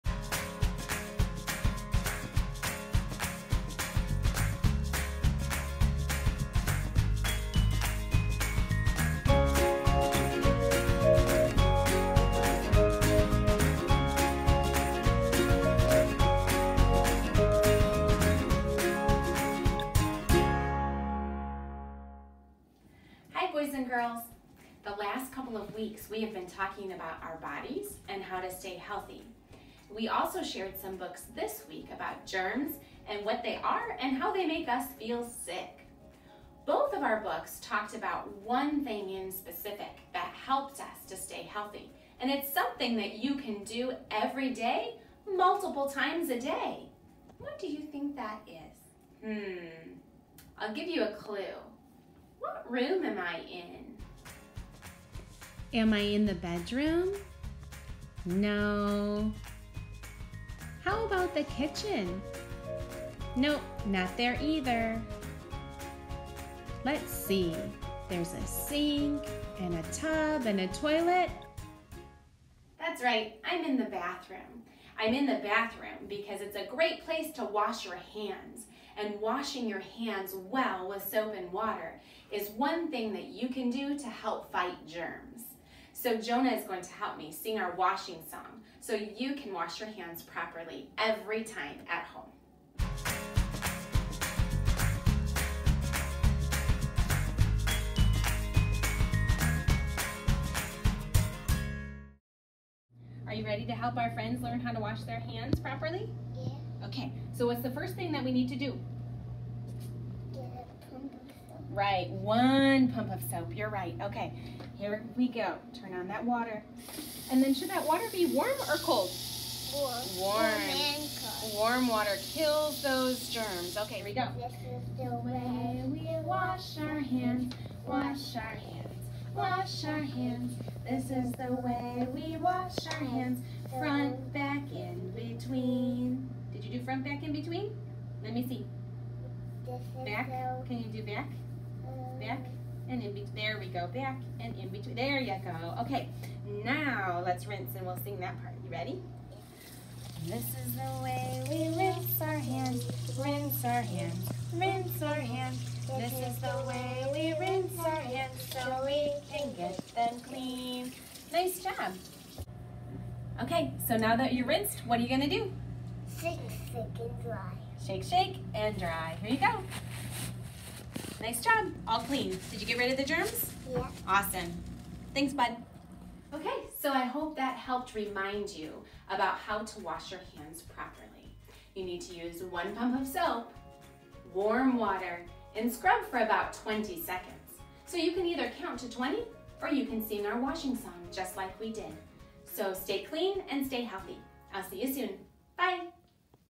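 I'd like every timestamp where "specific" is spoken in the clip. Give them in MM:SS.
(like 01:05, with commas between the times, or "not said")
00:39.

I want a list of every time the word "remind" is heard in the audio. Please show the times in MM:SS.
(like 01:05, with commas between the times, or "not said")
02:57.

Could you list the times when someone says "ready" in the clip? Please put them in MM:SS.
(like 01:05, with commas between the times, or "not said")
01:43, 02:28.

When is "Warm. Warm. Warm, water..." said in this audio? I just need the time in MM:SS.
01:59.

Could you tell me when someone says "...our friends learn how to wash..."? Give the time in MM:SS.
01:43.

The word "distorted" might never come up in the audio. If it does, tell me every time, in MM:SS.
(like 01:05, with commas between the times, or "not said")
not said.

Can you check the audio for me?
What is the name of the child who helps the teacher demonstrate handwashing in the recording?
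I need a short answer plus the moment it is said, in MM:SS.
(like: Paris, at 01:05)
Jonah, at 01:26.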